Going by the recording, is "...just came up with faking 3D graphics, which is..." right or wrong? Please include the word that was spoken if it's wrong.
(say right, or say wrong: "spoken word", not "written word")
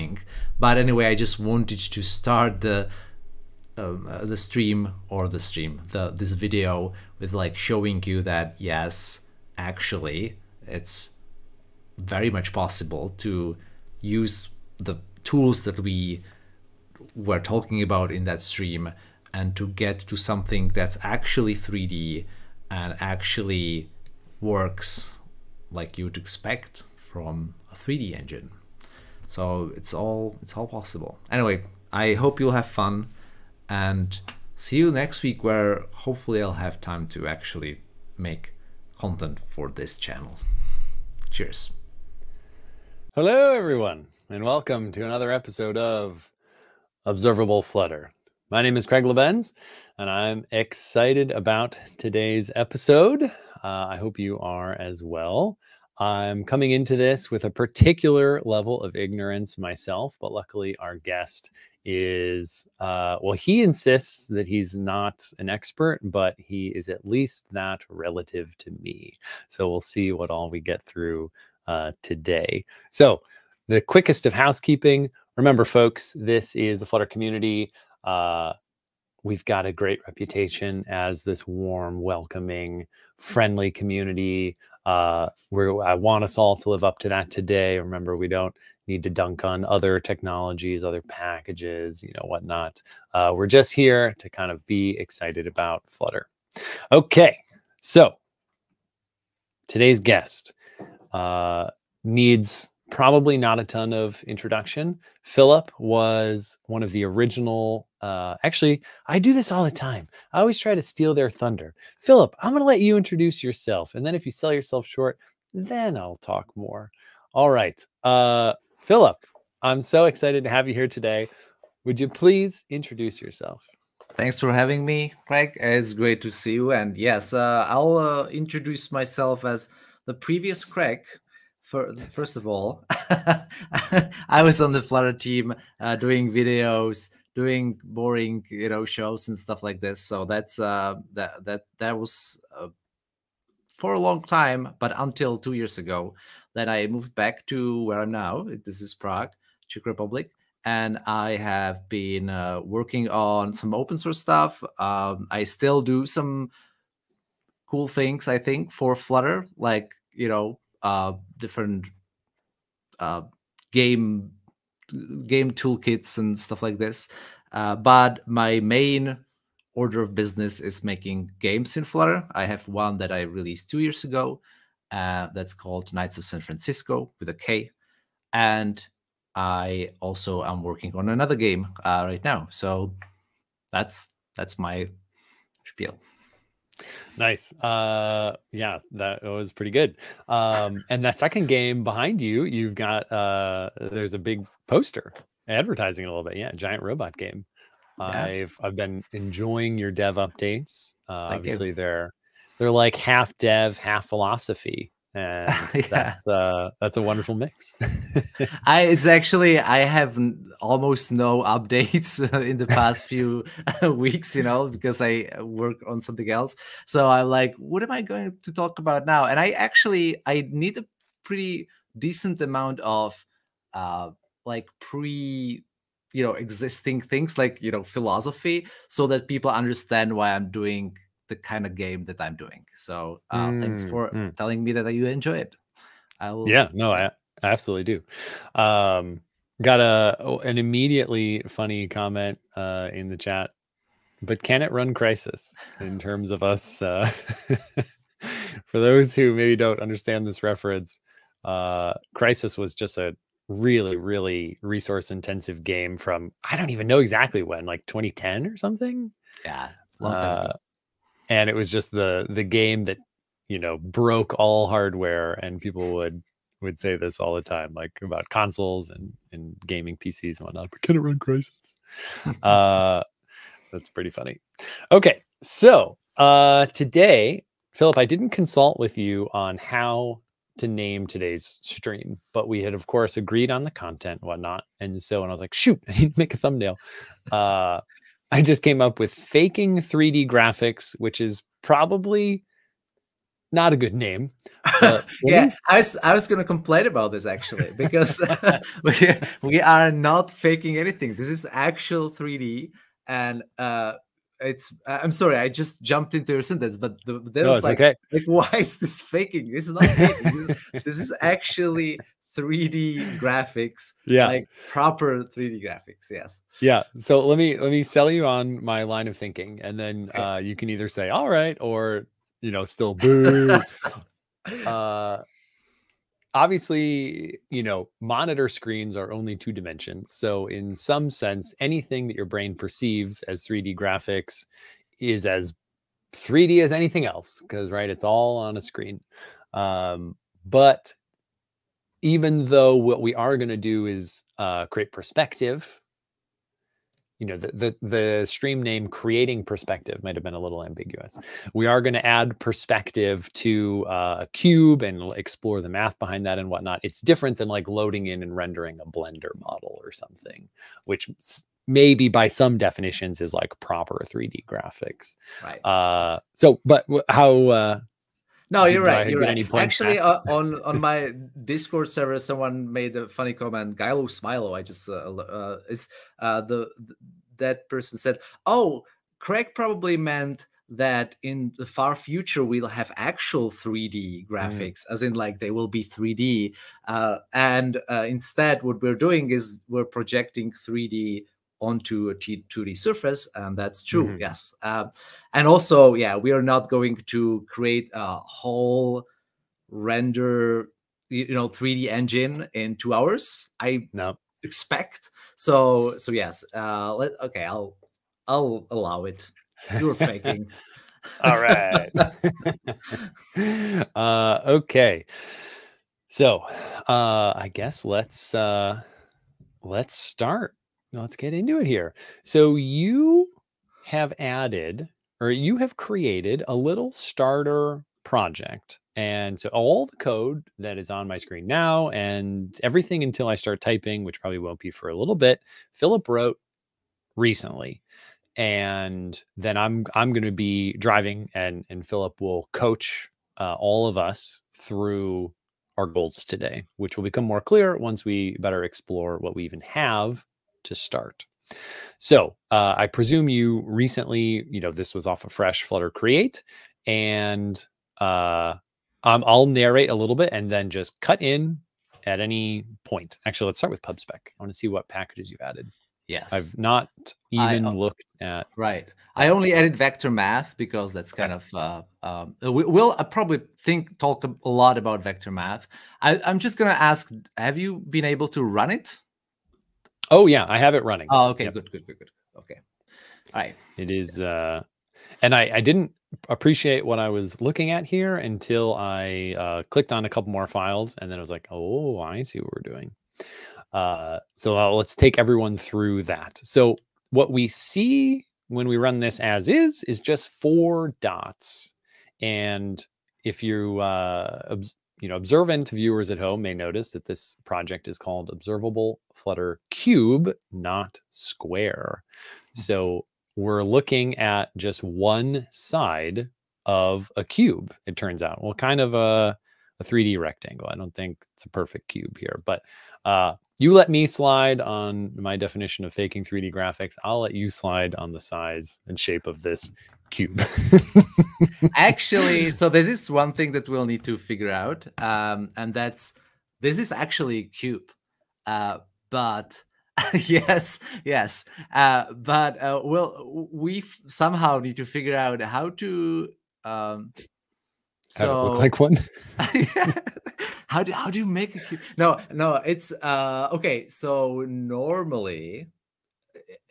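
right.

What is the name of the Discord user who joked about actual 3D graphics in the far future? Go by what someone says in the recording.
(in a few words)
Gylo Smilo.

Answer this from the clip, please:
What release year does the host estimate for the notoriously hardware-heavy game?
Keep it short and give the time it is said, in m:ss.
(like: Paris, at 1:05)
2010, at 4:17.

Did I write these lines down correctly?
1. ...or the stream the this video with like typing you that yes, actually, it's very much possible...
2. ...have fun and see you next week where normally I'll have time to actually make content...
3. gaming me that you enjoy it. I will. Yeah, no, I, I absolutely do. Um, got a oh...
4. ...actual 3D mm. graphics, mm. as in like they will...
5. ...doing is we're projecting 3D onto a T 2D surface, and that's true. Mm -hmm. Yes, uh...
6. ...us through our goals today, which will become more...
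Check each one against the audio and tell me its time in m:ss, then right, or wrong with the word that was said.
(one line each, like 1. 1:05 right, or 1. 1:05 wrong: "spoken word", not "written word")
1. 0:05 wrong: "showing", not "typing"
2. 0:32 wrong: "hopefully", not "normally"
3. 3:54 wrong: "telling", not "gaming"
4. 6:22 right
5. 6:28 right
6. 7:23 right.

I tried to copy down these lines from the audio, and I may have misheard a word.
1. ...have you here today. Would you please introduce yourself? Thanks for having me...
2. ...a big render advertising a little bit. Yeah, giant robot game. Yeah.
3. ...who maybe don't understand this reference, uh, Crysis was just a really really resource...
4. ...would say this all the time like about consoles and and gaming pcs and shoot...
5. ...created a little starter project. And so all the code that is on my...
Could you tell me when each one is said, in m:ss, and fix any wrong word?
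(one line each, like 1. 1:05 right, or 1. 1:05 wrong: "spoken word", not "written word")
1. 2:00 right
2. 3:14 wrong: "poster", not "render"
3. 4:09 right
4. 4:26 wrong: "whatnot", not "shoot"
5. 7:05 right.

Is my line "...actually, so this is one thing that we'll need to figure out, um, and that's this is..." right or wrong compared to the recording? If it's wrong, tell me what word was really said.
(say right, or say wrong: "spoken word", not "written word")
right.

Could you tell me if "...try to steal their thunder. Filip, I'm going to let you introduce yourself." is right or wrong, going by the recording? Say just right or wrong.
right.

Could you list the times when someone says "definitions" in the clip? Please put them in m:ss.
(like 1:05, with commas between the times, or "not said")
6:02, 8:45.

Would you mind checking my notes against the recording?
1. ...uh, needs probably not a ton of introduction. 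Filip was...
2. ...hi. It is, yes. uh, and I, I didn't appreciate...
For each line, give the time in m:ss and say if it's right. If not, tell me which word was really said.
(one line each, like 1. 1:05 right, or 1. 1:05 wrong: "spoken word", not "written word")
1. 1:41 right
2. 8:03 right.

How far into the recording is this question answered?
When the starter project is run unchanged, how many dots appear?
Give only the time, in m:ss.
8:20.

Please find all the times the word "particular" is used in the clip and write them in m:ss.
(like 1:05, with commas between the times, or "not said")
0:57.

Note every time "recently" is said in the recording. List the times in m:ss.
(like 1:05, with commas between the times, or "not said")
7:17, 7:33.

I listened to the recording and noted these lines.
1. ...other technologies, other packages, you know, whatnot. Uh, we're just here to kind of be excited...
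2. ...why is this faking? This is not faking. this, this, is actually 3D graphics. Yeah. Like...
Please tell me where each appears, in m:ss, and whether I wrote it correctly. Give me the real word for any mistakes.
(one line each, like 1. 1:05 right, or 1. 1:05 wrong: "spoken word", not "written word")
1. 1:29 right
2. 5:08 right.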